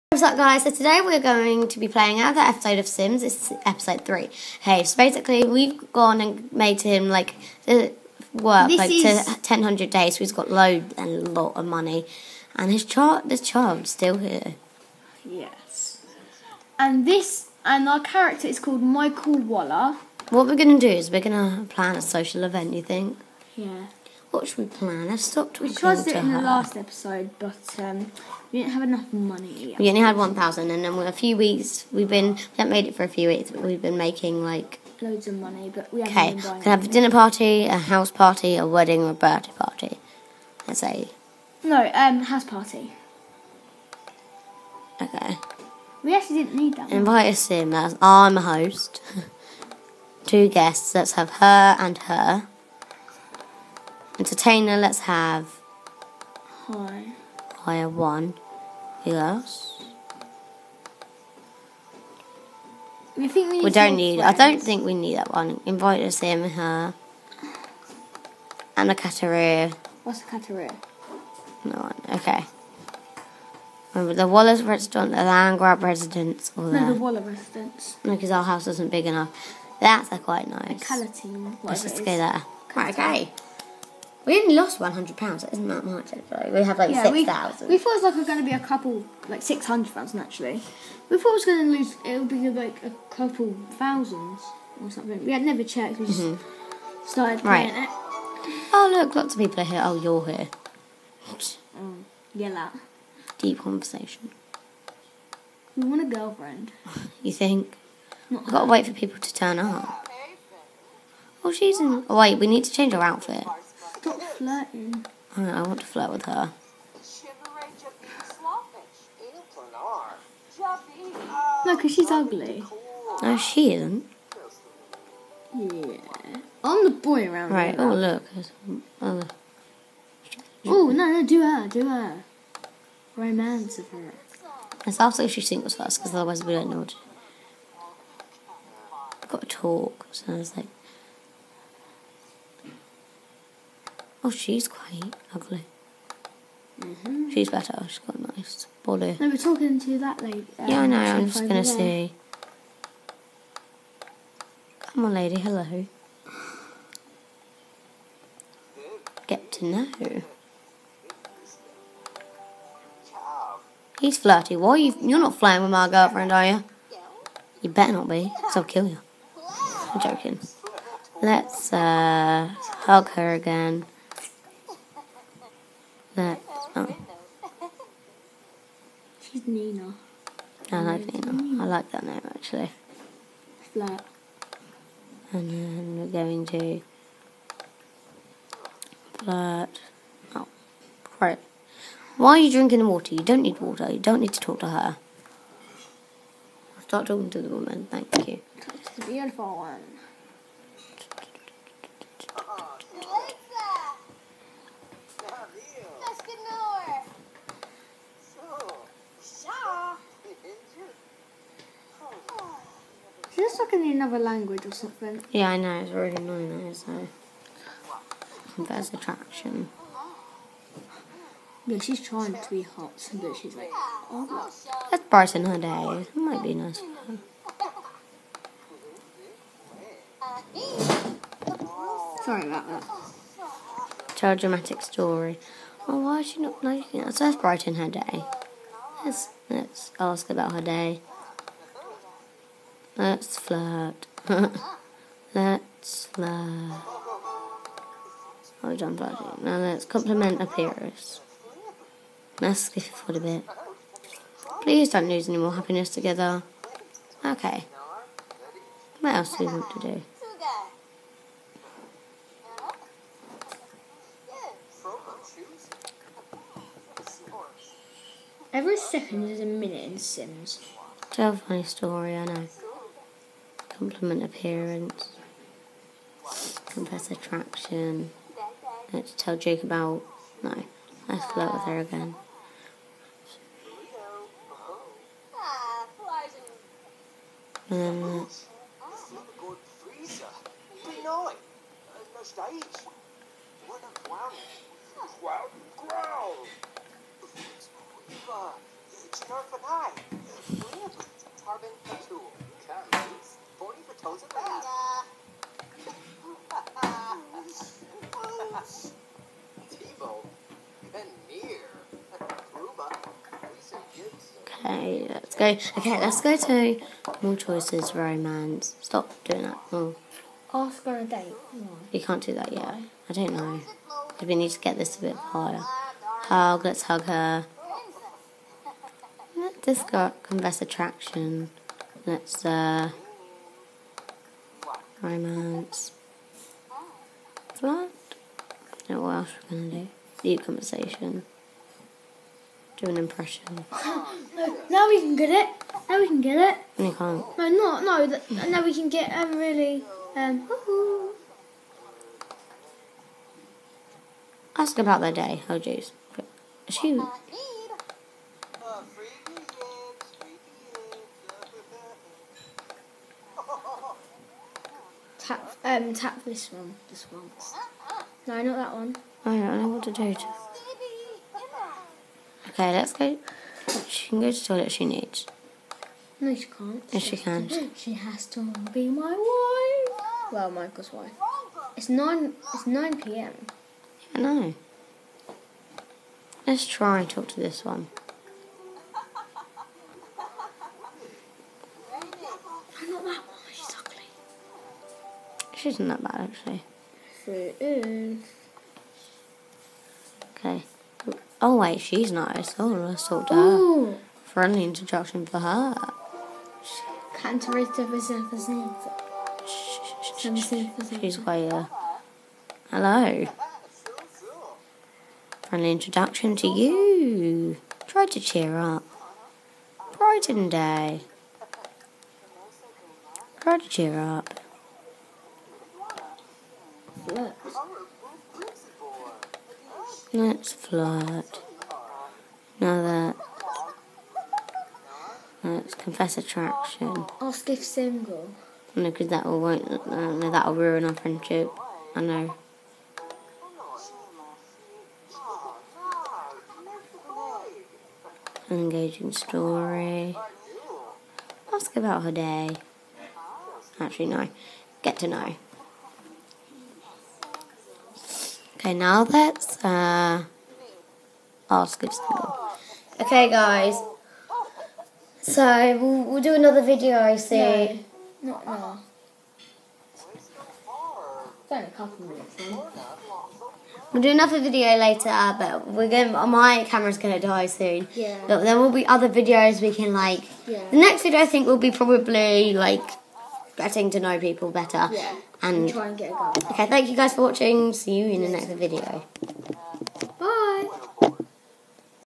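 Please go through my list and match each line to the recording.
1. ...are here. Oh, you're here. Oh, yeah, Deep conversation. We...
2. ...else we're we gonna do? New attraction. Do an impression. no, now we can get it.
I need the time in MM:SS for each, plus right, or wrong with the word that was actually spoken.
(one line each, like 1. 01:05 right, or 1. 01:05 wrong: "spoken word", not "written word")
1. 01:39 right
2. 05:39 wrong: "conversation", not "attraction".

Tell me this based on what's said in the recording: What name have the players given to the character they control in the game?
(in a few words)
Michael Waller.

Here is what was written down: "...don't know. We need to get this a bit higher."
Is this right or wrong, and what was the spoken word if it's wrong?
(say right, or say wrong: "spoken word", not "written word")
right.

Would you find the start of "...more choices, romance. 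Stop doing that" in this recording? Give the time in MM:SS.
05:17.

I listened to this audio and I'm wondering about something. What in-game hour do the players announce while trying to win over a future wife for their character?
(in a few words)
9 p.m.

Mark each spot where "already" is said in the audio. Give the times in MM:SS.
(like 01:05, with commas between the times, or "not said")
03:35.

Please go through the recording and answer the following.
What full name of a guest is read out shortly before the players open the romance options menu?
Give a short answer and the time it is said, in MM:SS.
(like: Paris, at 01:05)
Lisa Gibson, at 05:13.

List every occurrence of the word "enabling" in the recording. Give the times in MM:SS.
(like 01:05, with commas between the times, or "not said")
not said.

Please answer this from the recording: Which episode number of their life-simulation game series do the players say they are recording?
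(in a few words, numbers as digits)
3.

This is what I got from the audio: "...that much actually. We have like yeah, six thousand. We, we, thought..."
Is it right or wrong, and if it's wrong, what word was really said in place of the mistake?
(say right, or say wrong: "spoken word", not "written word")
right.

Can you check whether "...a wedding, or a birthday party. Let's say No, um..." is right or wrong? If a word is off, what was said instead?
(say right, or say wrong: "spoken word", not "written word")
right.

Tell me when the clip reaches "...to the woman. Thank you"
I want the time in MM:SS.
03:17.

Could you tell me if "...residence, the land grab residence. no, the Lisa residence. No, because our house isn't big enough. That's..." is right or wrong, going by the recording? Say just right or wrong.
wrong.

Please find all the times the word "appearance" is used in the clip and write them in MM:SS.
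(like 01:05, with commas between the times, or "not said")
04:10, 04:34.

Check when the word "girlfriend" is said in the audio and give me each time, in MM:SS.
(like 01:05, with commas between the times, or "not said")
01:46, 02:45.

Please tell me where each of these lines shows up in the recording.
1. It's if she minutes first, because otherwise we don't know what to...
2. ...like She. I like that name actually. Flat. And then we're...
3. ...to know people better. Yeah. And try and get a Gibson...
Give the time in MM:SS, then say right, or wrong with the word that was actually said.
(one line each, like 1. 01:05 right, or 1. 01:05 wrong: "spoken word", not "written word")
1. 02:14 wrong: "singles", not "minutes"
2. 03:00 wrong: "Nina", not "She"
3. 08:03 wrong: "Okay", not "Gibson".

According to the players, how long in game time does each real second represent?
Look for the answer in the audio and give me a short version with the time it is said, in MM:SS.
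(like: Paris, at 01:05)
A minute, at 04:29.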